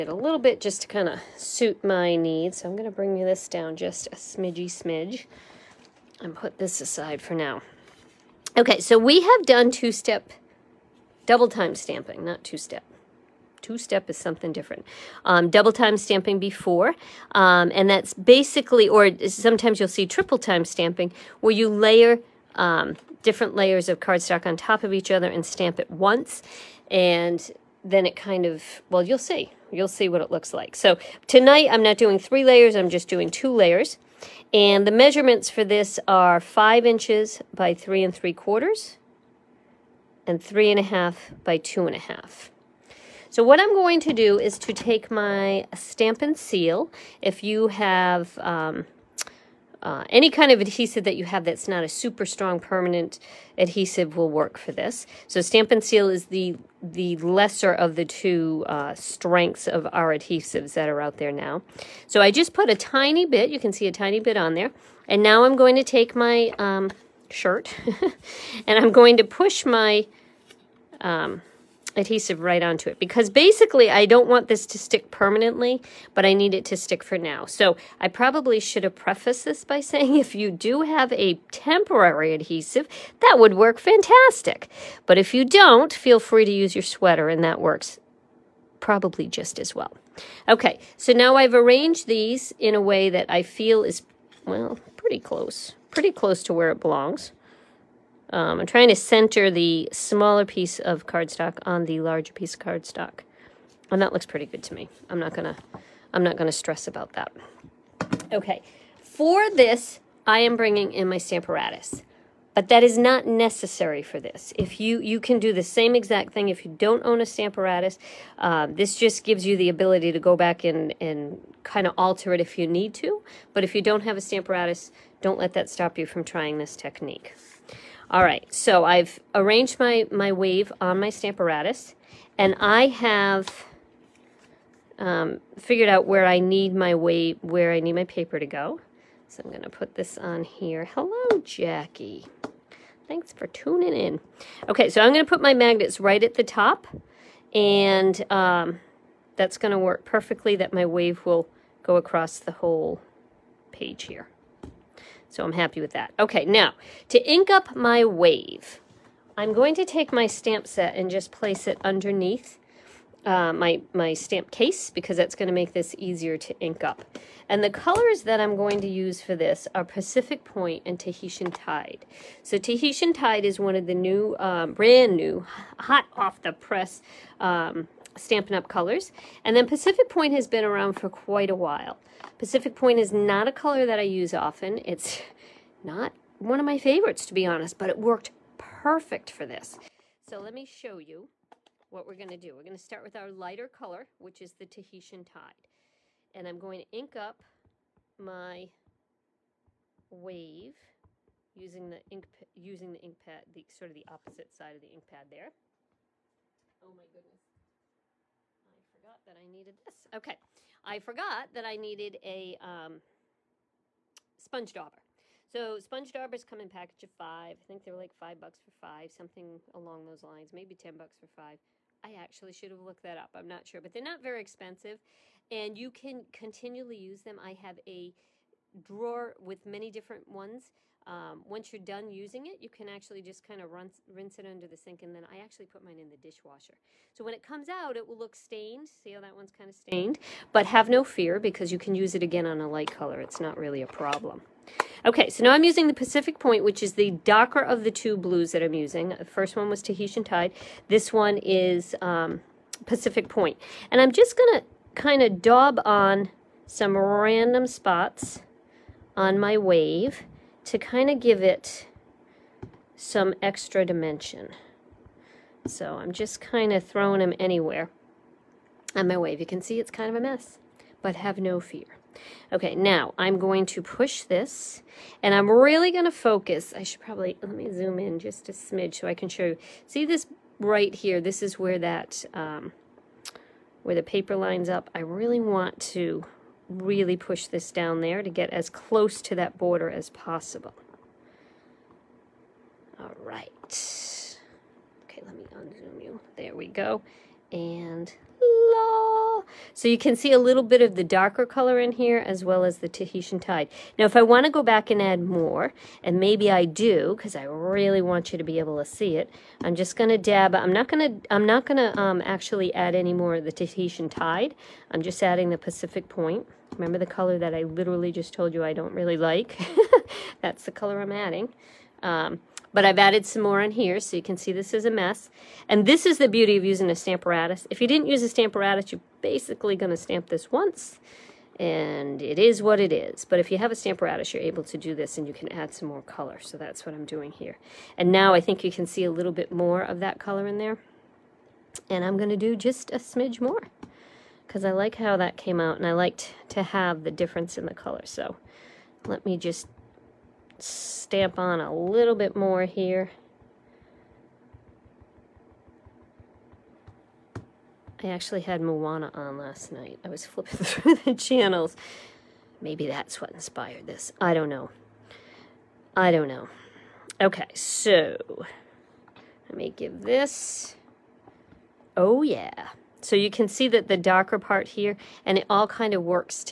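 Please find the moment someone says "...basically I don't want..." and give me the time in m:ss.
1:13.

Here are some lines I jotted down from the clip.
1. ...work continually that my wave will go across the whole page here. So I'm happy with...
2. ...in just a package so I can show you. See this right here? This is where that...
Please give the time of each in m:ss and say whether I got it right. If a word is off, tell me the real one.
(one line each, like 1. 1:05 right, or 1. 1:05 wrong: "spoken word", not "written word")
1. 2:29 wrong: "perfectly", not "continually"
2. 4:37 wrong: "smidge", not "package".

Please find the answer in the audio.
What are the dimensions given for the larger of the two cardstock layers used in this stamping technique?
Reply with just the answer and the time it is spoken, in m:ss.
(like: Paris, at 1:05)
5 inches by 3 3/4, at 0:36.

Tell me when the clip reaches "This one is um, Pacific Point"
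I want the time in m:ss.
4:10.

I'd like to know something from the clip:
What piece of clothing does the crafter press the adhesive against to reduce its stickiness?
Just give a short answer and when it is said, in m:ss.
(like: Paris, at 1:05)
shirt, at 1:07.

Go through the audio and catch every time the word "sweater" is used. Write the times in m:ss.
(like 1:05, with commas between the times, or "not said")
1:26.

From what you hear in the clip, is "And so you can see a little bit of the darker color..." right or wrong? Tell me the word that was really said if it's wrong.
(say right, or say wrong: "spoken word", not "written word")
right.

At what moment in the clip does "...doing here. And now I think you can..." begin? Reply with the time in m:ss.
5:37.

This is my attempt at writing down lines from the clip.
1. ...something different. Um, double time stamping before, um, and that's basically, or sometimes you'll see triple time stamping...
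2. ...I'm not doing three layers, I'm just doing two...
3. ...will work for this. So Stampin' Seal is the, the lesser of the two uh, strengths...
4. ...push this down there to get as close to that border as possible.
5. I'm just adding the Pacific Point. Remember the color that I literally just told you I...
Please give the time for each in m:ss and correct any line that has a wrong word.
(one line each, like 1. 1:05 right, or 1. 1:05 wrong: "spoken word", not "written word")
1. 0:14 right
2. 0:31 right
3. 0:54 right
4. 4:47 right
5. 5:14 right.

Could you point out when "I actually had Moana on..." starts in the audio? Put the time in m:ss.
5:58.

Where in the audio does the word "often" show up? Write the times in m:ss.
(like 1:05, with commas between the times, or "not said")
3:04.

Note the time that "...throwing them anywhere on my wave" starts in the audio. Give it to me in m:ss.
4:26.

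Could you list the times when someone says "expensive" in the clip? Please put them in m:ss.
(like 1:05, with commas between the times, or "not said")
3:44.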